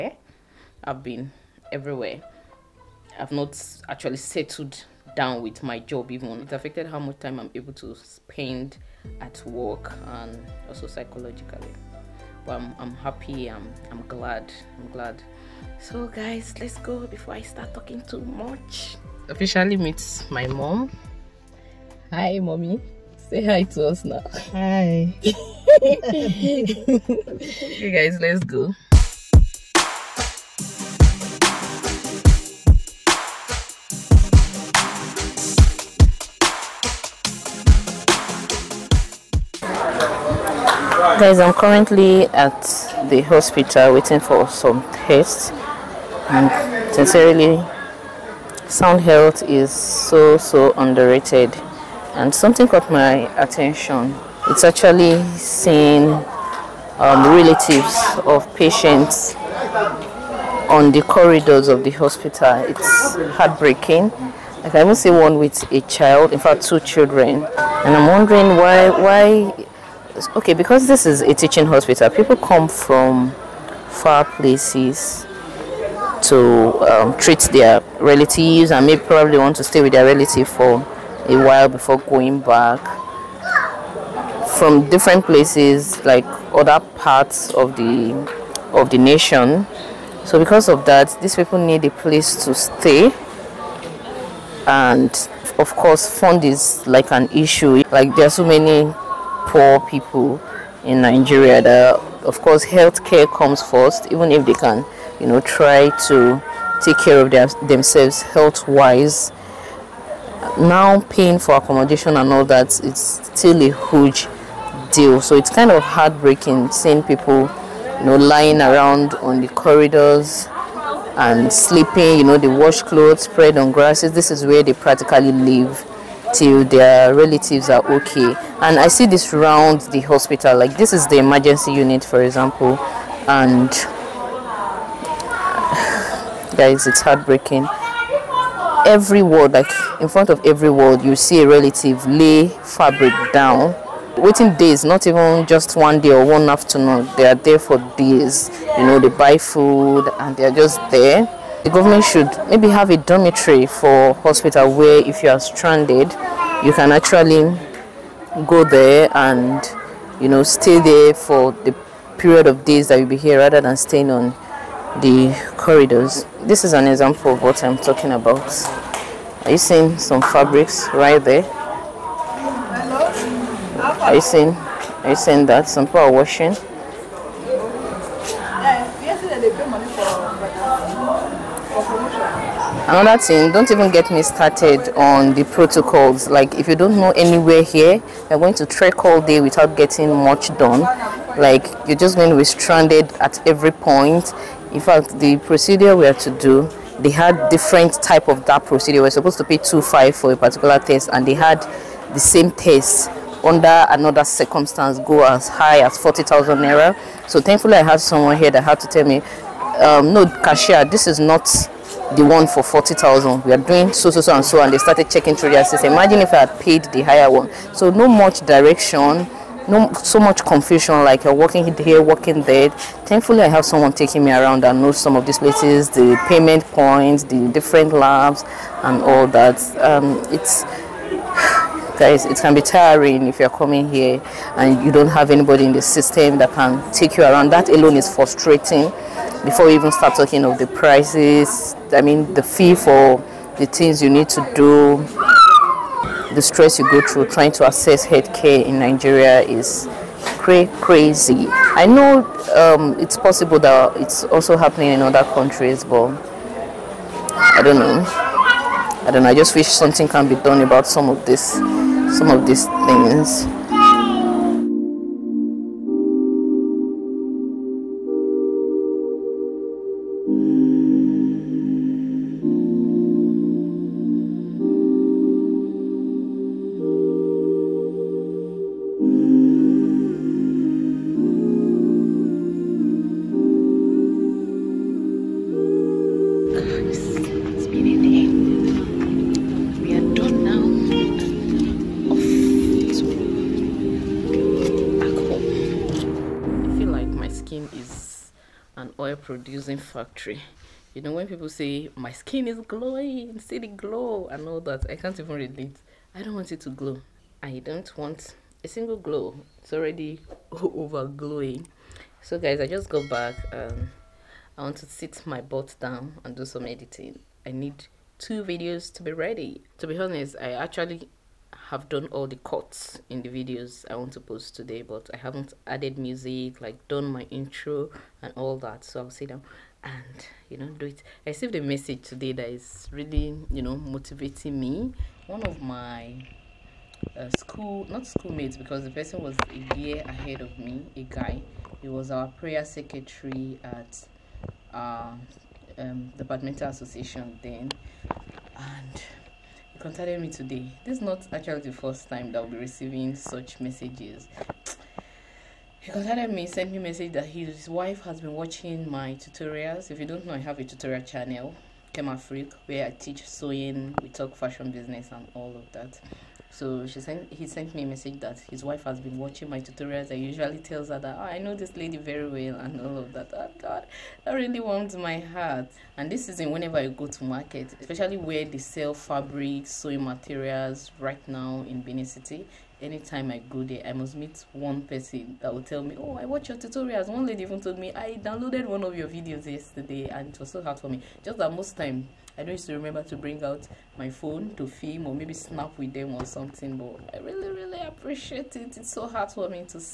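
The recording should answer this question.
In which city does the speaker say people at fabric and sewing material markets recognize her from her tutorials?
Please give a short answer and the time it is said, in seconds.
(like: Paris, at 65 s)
Benin City, at 381 s.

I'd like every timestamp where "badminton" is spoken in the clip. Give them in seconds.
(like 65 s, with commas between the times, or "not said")
346 s.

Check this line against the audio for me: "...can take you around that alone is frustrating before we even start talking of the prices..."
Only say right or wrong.
right.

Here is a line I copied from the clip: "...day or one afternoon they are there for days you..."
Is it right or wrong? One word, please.
right.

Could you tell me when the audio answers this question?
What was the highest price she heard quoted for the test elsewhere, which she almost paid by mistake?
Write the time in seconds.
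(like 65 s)
205 s.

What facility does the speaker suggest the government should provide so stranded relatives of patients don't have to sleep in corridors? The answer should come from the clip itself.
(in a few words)
dormitory.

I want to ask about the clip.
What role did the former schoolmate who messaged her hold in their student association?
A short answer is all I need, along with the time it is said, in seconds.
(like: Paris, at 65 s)
prayer secretary, at 342 s.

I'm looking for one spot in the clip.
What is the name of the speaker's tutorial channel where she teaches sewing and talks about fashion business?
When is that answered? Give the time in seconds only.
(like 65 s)
361 s.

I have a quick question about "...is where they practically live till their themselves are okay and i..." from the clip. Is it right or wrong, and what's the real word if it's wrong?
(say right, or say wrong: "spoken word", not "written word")
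wrong: "relatives", not "themselves".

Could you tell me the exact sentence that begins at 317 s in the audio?
I need two videos to be ready.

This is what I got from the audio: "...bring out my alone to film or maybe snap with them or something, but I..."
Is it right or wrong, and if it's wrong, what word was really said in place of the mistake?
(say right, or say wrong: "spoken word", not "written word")
wrong: "phone", not "alone".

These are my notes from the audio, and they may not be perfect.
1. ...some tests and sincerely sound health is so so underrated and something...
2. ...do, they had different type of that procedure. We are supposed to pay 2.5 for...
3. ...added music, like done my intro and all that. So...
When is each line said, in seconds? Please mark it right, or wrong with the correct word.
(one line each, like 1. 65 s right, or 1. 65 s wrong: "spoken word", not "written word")
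1. 44 s right
2. 196 s right
3. 325 s right.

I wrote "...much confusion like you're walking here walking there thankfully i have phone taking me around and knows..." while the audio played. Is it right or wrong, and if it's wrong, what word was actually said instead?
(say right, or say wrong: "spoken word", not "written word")
wrong: "someone", not "phone".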